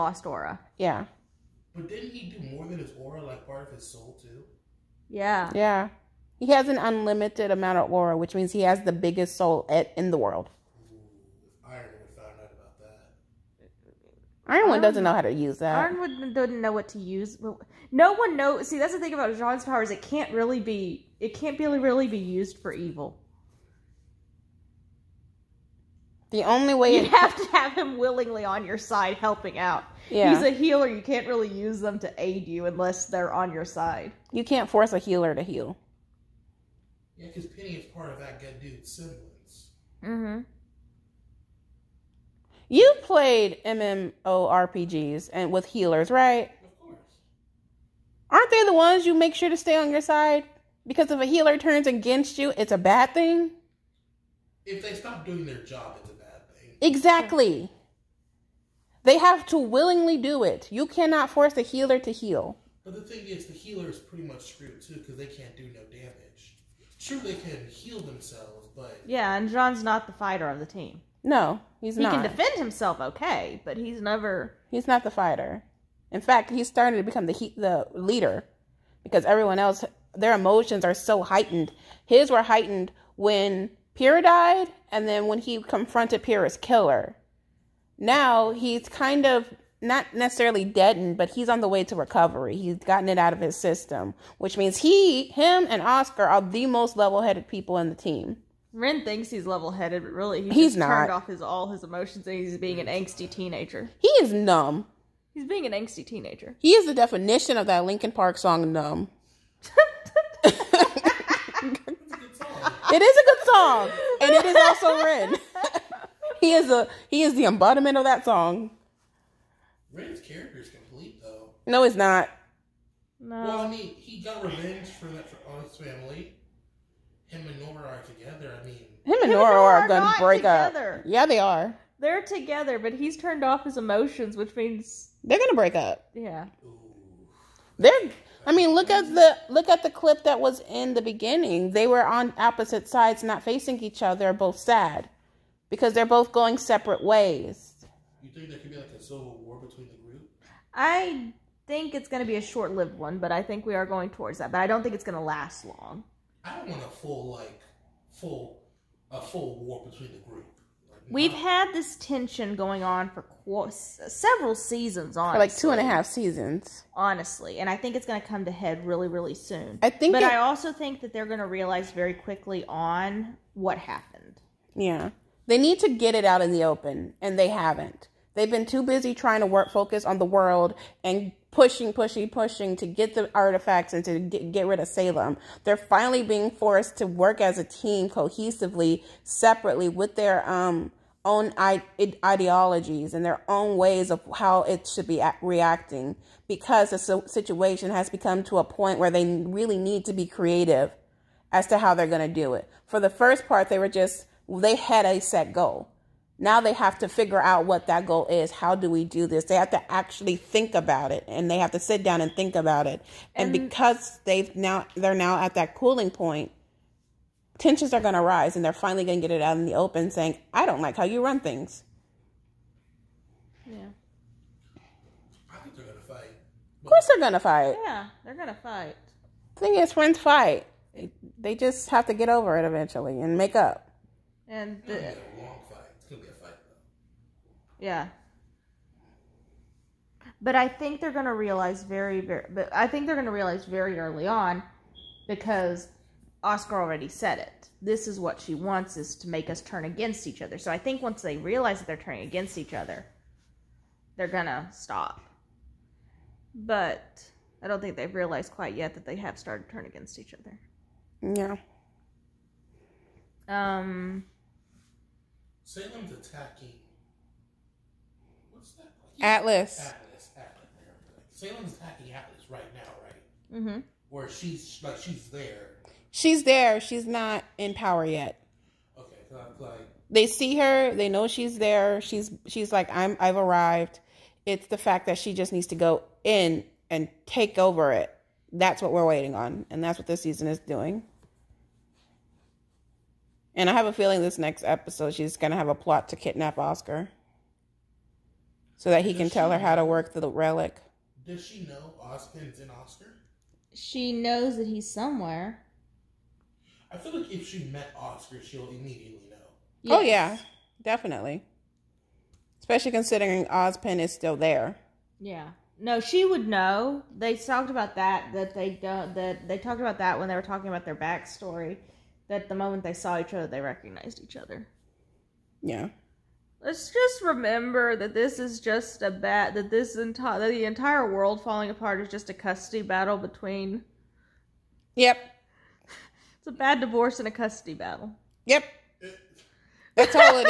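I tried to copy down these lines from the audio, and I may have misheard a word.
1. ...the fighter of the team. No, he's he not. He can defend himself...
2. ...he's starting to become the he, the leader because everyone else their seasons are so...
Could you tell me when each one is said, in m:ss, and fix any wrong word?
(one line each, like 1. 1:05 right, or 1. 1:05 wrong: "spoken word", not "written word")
1. 1:10 right
2. 1:16 wrong: "emotions", not "seasons".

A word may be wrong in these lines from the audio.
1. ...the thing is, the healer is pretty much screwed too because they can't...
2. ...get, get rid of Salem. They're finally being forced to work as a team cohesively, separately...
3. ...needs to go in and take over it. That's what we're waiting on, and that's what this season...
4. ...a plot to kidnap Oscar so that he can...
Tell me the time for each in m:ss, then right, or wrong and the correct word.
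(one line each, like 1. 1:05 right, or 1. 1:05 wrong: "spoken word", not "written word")
1. 1:02 right
2. 3:04 right
3. 4:45 right
4. 4:55 right.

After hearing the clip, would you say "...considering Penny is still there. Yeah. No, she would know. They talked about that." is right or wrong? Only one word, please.
wrong.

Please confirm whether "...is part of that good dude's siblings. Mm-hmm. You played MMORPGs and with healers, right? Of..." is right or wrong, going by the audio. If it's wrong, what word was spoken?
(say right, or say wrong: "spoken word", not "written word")
right.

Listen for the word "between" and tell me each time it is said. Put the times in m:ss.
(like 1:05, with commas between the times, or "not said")
2:29, 2:39, 5:33.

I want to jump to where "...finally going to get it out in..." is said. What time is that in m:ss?
3:38.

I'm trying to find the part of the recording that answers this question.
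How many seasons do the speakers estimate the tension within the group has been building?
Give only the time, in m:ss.
2:45.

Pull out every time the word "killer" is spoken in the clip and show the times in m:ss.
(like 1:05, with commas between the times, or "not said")
1:26.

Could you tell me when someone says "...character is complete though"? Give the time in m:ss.
2:00.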